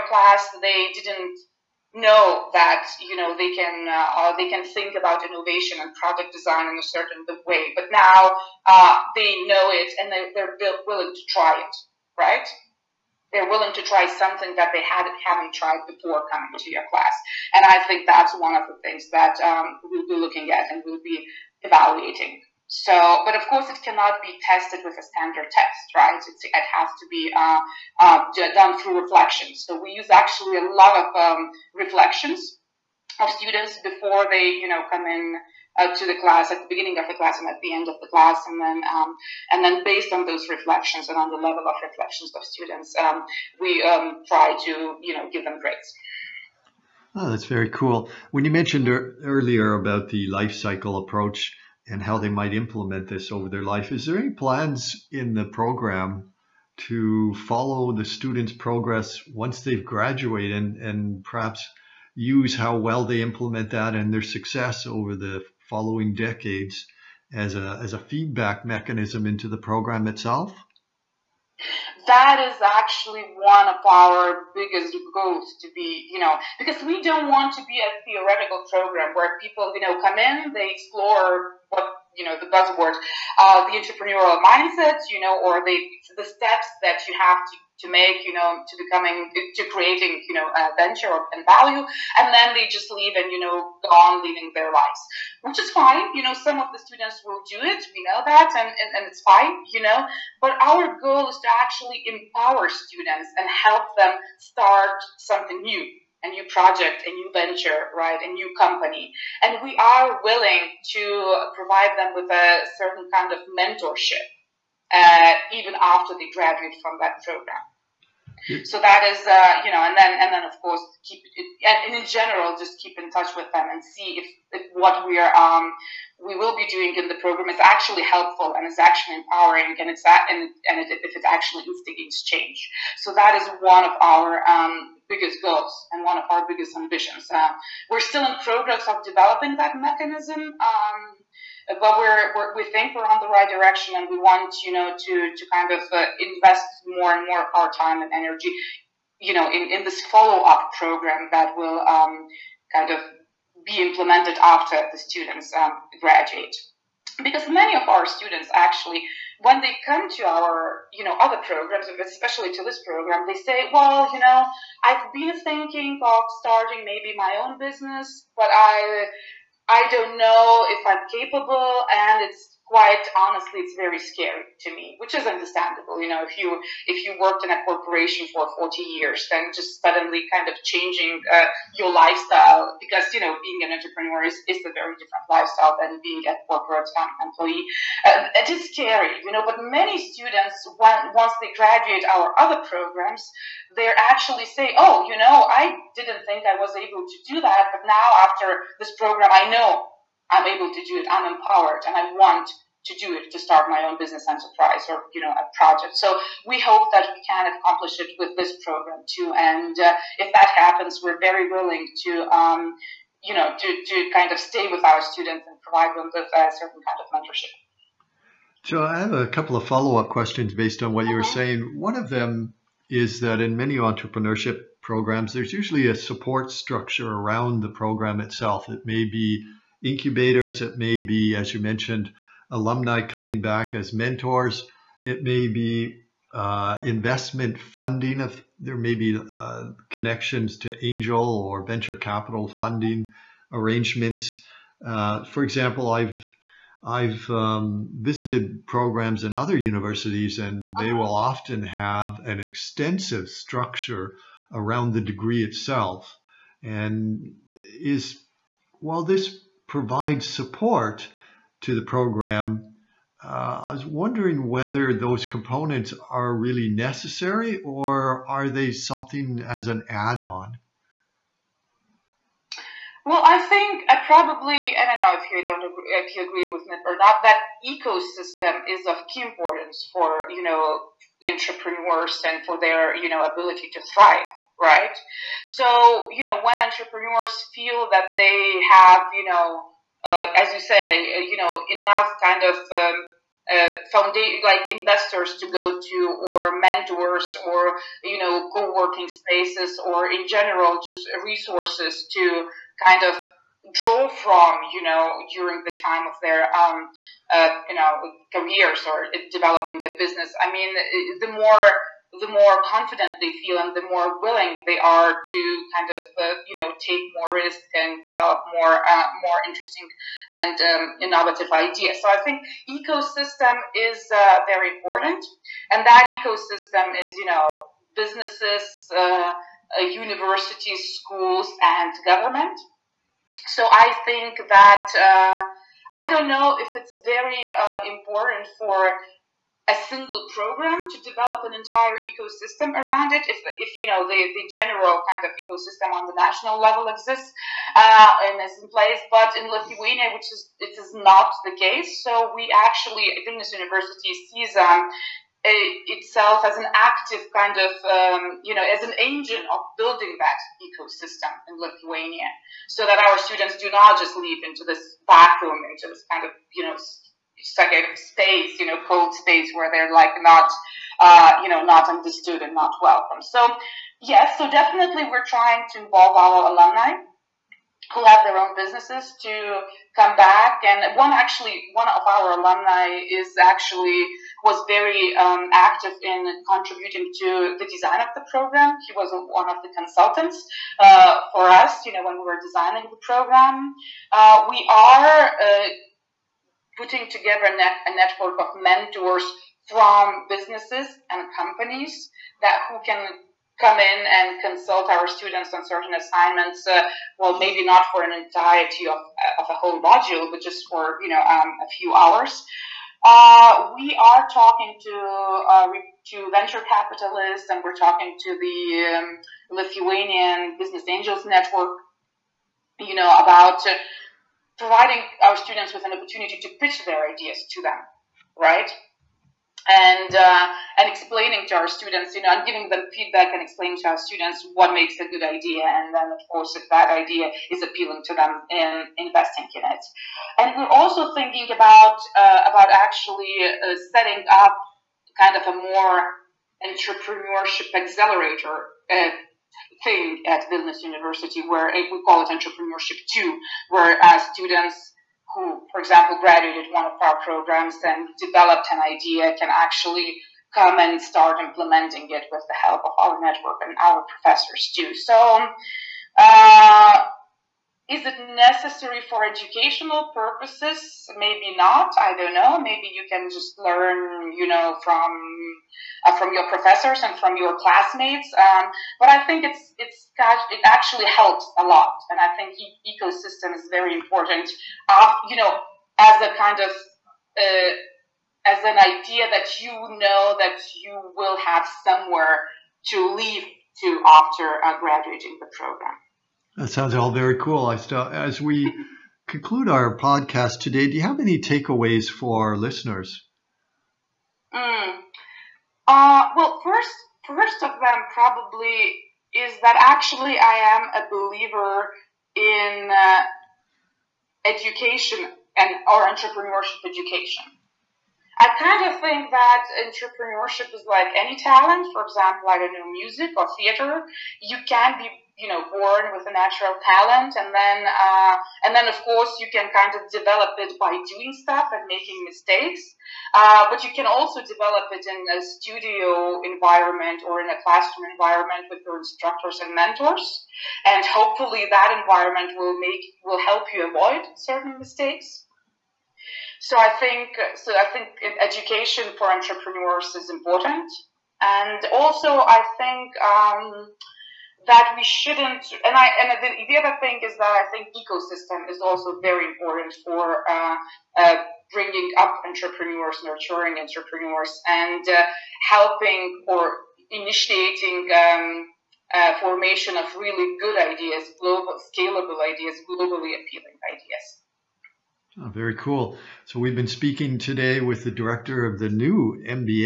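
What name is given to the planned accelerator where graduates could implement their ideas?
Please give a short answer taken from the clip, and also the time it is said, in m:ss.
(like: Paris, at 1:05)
entrepreneurship two, at 7:32.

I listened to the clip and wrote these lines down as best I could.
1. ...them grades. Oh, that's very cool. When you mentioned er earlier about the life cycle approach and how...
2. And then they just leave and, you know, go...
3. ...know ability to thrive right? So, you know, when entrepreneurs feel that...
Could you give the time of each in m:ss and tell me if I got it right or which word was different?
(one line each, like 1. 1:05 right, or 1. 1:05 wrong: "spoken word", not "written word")
1. 0:45 right
2. 1:32 right
3. 4:43 right.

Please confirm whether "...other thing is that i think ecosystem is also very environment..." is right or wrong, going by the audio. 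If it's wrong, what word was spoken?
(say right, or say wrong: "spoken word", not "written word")
wrong: "important", not "environment".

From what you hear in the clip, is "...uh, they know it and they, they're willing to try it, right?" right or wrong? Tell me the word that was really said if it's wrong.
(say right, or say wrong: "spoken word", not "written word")
right.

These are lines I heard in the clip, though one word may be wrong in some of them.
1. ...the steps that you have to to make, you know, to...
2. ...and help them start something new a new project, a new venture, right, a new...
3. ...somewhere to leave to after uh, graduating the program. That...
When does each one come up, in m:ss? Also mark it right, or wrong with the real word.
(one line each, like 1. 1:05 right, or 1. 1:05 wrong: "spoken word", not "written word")
1. 1:26 right
2. 1:43 right
3. 8:11 right.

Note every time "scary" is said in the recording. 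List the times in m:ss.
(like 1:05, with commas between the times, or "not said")
2:53, 3:08.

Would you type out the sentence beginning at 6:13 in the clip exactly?
So yes, so definitely we're trying to involve our alumni who have their own businesses to come back.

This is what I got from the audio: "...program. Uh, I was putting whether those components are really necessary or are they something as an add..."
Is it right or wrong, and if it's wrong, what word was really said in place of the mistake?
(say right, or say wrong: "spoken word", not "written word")
wrong: "wondering", not "putting".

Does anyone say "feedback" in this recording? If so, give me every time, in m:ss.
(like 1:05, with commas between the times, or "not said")
1:07, 7:12.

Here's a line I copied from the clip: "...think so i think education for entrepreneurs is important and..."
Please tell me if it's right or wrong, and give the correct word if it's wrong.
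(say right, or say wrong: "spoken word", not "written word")
right.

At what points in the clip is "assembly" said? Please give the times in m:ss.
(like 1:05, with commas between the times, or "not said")
not said.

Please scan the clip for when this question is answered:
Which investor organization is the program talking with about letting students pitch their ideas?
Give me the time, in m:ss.
6:59.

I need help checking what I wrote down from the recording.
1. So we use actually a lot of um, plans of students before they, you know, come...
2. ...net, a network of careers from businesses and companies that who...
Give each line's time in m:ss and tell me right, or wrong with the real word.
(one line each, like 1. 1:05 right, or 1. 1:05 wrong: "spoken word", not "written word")
1. 0:29 wrong: "reflections", not "plans"
2. 6:37 wrong: "mentors", not "careers".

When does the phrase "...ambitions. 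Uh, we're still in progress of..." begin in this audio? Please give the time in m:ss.
2:16.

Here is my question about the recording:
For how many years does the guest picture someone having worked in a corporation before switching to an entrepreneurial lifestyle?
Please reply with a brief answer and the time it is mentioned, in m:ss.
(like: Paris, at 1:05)
40, at 2:58.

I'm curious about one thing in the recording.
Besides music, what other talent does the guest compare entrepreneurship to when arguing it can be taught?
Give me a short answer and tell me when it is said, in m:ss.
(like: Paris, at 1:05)
Theater, at 8:43.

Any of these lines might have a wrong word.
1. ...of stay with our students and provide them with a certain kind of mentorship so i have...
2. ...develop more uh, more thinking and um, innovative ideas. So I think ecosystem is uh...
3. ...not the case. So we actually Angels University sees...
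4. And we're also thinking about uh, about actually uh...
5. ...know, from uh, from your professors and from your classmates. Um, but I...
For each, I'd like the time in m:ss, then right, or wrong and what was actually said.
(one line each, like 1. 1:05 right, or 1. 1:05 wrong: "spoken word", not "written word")
1. 3:34 right
2. 5:18 wrong: "interesting", not "thinking"
3. 5:50 wrong: "Vilnius", not "Angels"
4. 7:20 right
5. 7:54 right.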